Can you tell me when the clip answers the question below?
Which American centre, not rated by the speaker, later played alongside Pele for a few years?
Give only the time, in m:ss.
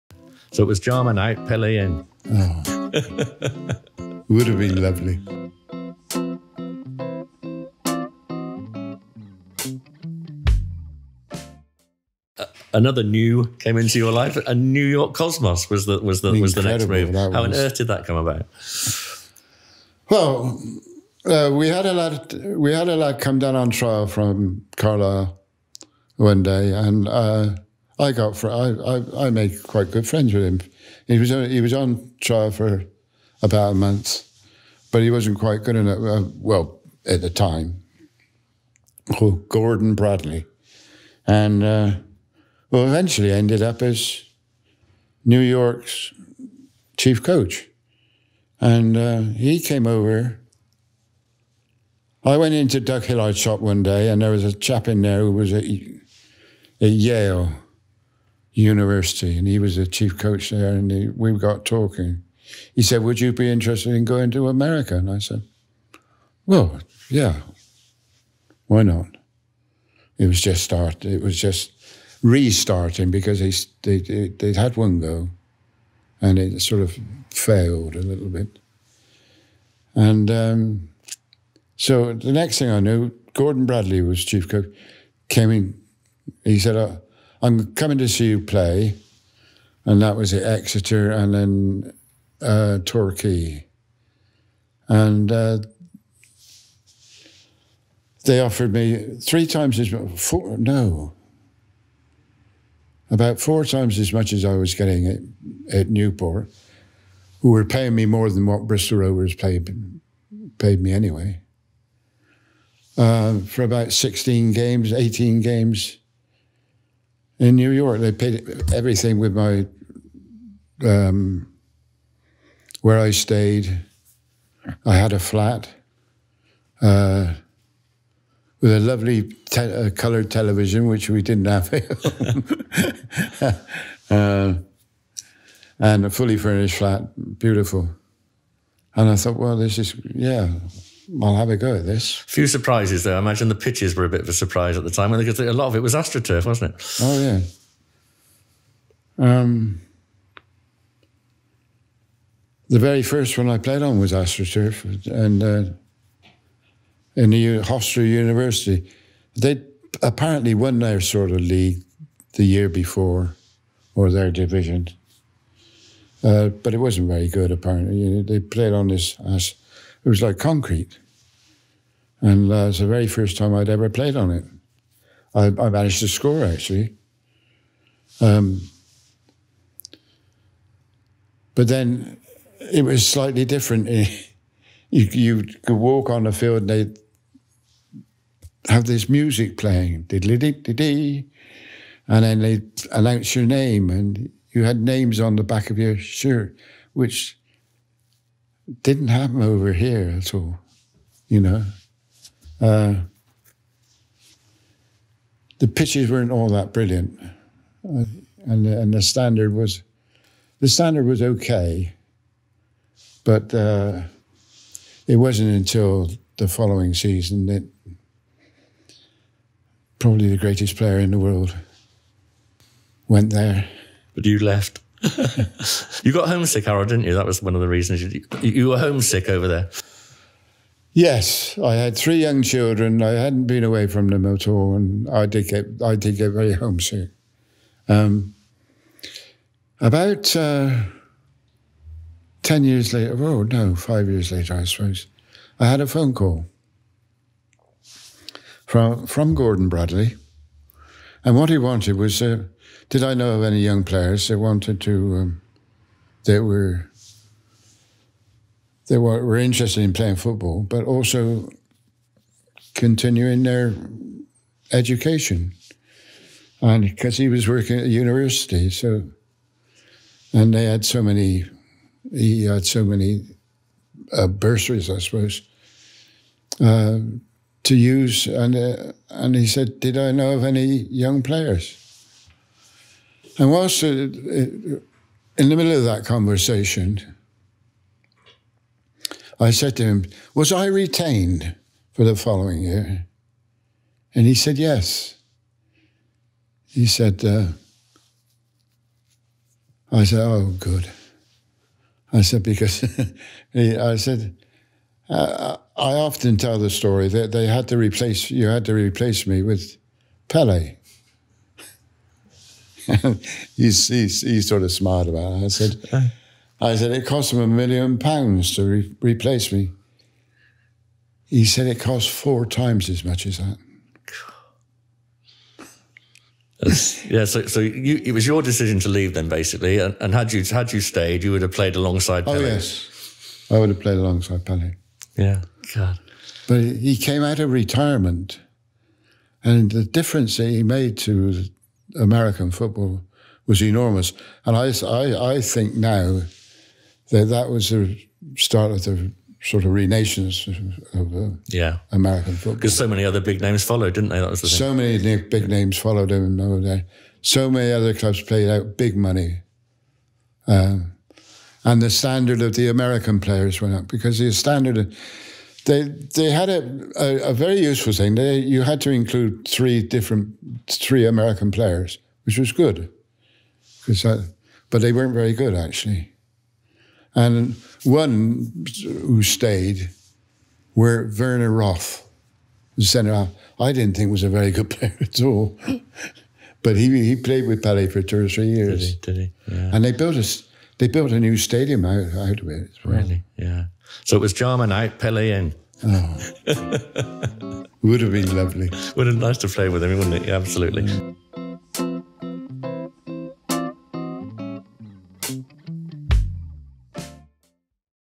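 6:21.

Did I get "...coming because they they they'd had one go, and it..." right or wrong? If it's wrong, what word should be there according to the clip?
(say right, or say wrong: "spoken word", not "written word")
wrong: "restarting", not "coming".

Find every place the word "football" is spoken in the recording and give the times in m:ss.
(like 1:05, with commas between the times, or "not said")
4:20, 5:42, 5:52.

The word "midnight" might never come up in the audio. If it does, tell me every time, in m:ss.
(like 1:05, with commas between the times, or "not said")
not said.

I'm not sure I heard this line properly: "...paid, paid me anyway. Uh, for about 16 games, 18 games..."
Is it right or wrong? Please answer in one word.
right.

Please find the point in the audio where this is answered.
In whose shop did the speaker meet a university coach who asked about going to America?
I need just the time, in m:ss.
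0:52.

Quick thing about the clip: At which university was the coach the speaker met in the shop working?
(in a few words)
Yale University.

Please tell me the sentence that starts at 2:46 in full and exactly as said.
Uh, but it wasn't very good, apparently.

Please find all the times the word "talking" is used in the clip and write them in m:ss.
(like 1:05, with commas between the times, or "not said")
1:01.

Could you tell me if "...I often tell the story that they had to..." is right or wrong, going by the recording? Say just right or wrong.
right.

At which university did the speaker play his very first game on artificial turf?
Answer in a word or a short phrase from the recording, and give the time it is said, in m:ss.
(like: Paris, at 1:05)
Hofstra University, at 2:37.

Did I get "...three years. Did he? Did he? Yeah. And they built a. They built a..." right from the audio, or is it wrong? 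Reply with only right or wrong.
right.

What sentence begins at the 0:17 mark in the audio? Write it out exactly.
How on earth did that come about?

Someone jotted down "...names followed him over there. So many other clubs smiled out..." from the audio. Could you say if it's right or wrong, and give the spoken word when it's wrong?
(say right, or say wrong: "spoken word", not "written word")
wrong: "played", not "smiled".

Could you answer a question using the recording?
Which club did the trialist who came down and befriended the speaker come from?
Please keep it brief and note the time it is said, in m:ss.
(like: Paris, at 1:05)
Carlisle, at 0:24.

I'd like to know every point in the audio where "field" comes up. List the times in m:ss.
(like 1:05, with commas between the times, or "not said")
3:06.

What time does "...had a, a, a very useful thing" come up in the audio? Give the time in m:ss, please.
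6:06.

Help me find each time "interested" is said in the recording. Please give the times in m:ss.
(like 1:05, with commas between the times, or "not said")
1:03, 4:19.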